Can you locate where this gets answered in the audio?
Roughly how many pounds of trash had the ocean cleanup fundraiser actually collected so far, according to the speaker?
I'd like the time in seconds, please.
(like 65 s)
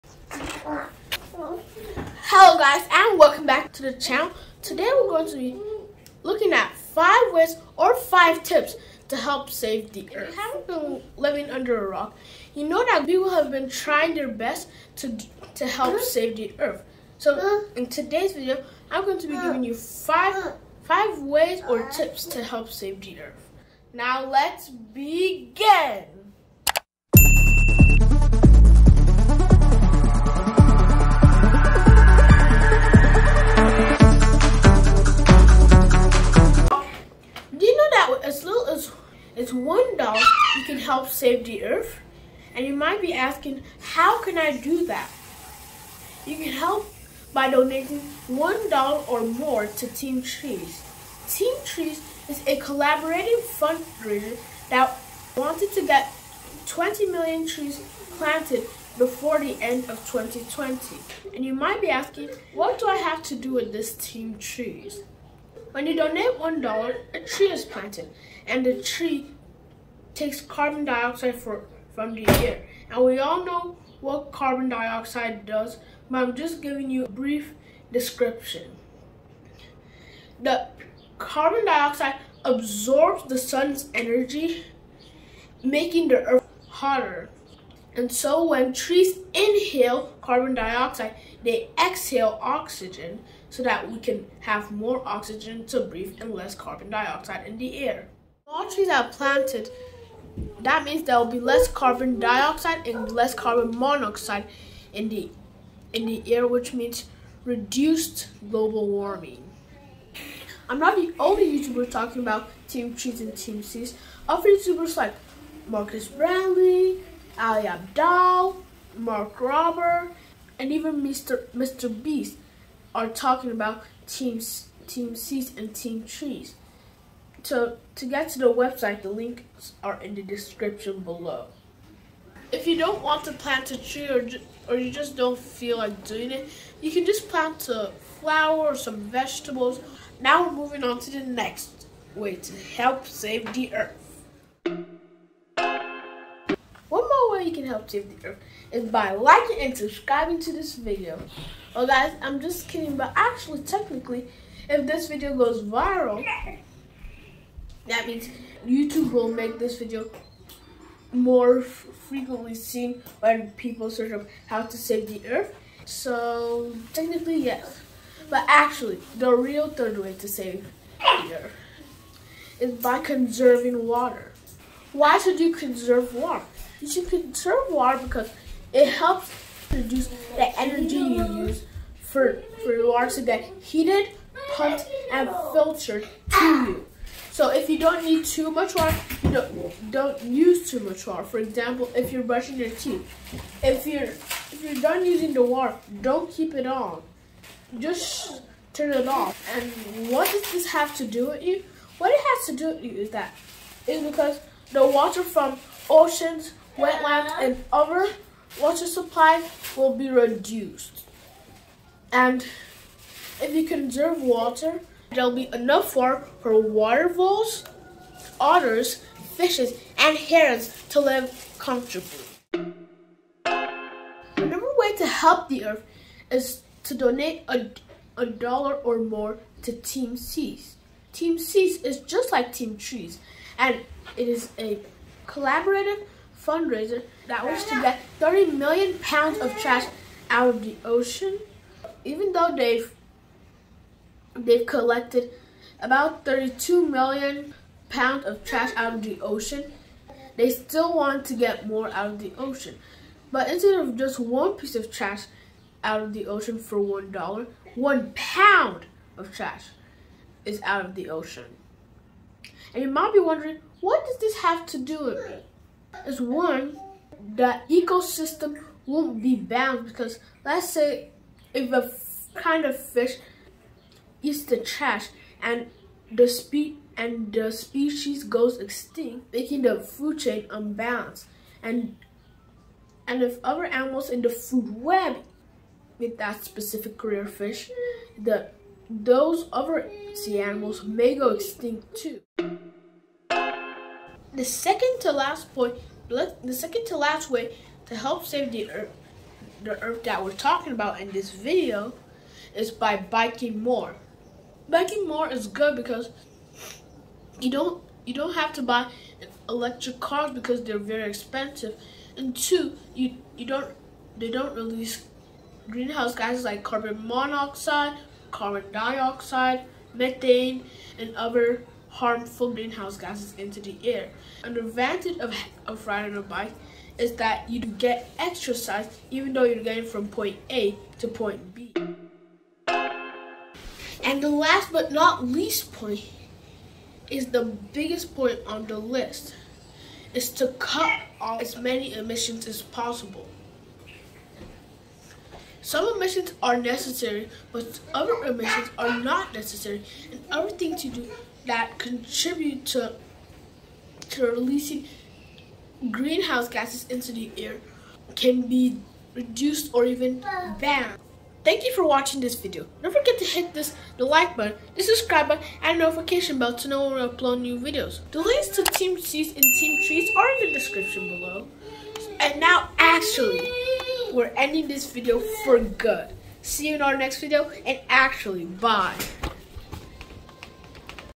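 246 s.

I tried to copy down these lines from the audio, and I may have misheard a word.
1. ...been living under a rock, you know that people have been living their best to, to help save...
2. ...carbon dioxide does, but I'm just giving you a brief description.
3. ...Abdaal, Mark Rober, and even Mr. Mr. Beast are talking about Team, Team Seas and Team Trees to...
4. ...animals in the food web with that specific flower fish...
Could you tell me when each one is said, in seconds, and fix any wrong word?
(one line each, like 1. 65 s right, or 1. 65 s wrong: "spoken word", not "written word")
1. 10 s wrong: "trying", not "living"
2. 74 s right
3. 117 s right
4. 283 s wrong: "career", not "flower".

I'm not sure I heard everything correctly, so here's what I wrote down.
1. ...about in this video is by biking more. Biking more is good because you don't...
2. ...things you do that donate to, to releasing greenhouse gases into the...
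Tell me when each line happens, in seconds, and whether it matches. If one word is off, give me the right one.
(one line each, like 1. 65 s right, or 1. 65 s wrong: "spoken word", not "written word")
1. 300 s right
2. 350 s wrong: "contribute", not "donate".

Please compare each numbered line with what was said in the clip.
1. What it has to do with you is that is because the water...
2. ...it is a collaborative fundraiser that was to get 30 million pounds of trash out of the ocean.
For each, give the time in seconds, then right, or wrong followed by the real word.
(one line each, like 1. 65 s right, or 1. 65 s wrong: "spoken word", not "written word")
1. 201 s right
2. 234 s right.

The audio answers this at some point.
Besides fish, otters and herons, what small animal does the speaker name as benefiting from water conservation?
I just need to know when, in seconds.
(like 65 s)
216 s.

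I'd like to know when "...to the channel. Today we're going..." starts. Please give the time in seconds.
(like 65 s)
3 s.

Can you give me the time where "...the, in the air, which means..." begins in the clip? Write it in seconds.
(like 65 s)
105 s.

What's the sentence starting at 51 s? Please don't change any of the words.
Team Trees is a collaborative fundraiser that wanted to get 20 million trees planted before the end of 2020.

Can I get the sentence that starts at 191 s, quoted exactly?
For example, if you're brushing your teeth, if you're if you're done using the water, don't keep it on.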